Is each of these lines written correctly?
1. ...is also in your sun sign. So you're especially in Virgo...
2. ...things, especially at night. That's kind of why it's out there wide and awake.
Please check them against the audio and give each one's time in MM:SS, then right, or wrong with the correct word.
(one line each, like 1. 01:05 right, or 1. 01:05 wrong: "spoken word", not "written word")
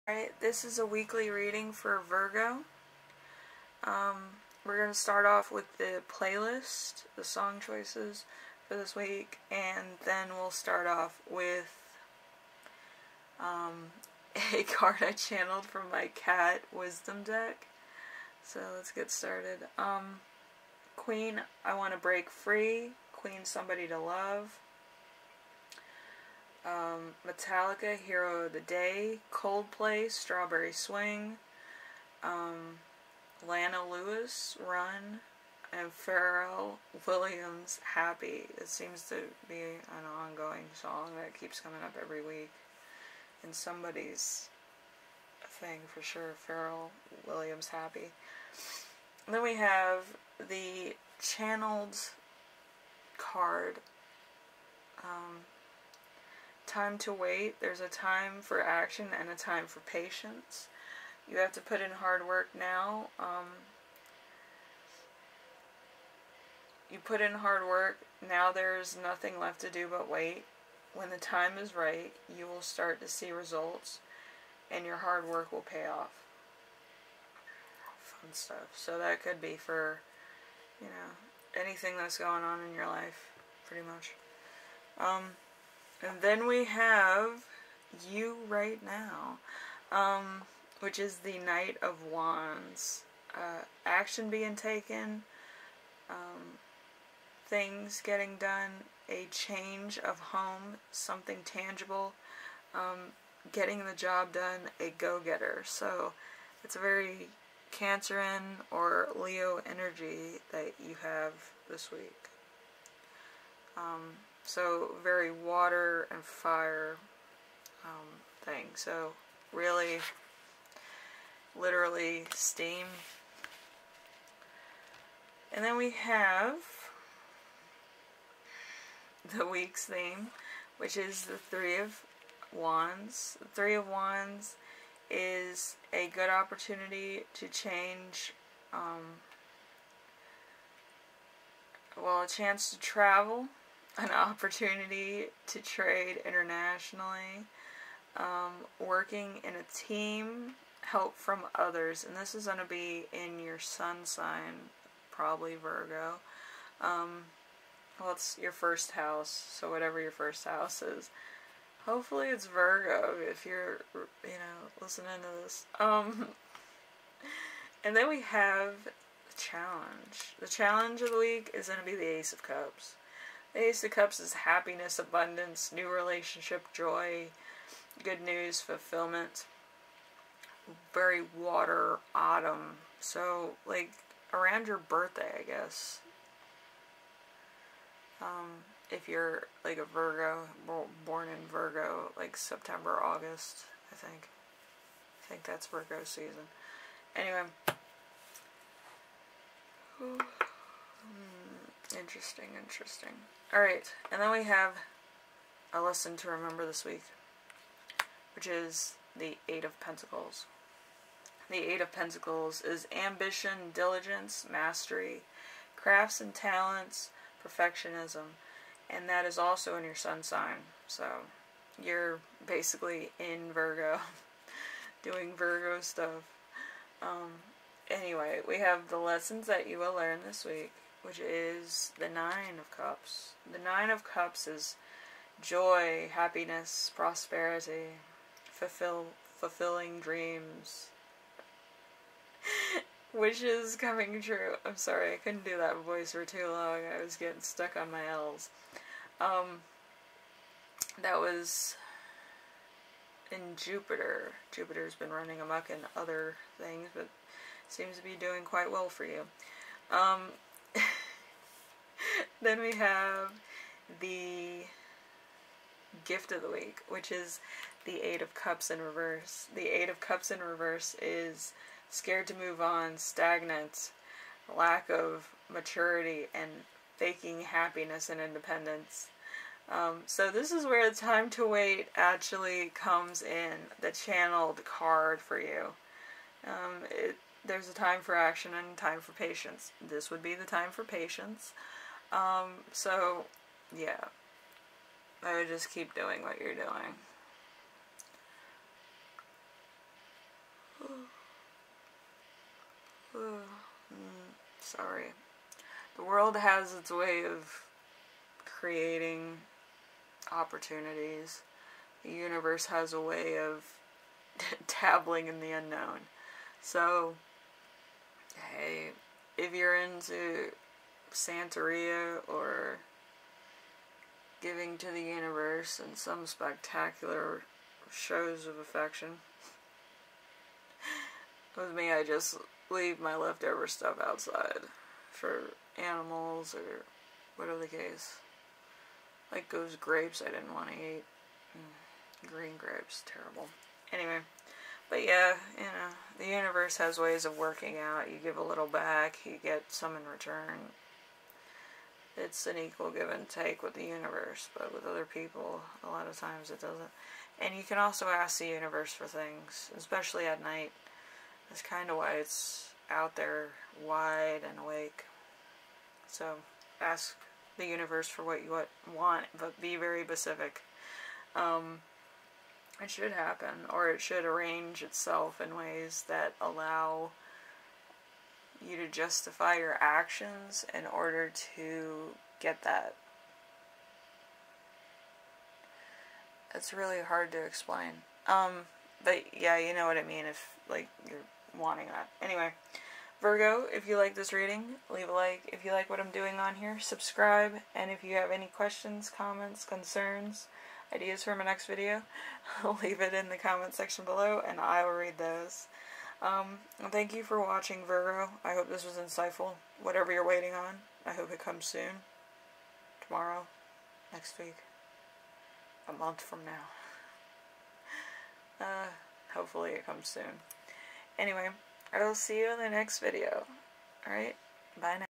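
1. 03:39 wrong: "basically", not "especially"
2. 05:59 right.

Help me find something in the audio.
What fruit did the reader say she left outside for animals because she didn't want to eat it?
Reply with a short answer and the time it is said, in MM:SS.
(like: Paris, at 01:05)
Green grapes, at 05:42.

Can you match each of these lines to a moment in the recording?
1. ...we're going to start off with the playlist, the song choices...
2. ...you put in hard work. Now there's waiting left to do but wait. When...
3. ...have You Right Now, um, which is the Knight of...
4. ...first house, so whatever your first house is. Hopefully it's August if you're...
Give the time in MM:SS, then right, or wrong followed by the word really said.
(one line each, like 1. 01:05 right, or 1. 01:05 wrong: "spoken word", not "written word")
1. 00:04 right
2. 01:06 wrong: "nothing", not "waiting"
3. 01:26 right
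4. 02:38 wrong: "Virgo", not "August".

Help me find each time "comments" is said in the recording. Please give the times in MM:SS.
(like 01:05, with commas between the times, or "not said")
06:39, 06:43.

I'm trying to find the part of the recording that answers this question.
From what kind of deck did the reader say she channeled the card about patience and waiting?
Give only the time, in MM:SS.
00:16.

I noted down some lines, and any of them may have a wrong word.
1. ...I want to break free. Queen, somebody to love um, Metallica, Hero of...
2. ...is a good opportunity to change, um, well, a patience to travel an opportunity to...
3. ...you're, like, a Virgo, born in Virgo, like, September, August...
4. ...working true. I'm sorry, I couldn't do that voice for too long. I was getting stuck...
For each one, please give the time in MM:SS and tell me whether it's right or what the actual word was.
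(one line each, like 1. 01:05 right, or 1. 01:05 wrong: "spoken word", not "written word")
1. 00:21 right
2. 02:15 wrong: "chance", not "patience"
3. 03:09 right
4. 04:03 wrong: "coming", not "working".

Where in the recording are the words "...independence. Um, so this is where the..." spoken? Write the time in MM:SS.
04:38.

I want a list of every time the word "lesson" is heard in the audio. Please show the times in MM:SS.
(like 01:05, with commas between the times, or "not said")
03:25, 03:48.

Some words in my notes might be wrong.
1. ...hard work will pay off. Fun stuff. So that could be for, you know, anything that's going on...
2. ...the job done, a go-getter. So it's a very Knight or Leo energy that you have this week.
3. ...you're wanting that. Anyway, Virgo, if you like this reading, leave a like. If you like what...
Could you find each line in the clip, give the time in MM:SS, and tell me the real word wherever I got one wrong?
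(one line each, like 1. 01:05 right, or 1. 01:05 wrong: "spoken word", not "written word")
1. 01:14 right
2. 01:43 wrong: "Cancerian", not "Knight"
3. 06:31 right.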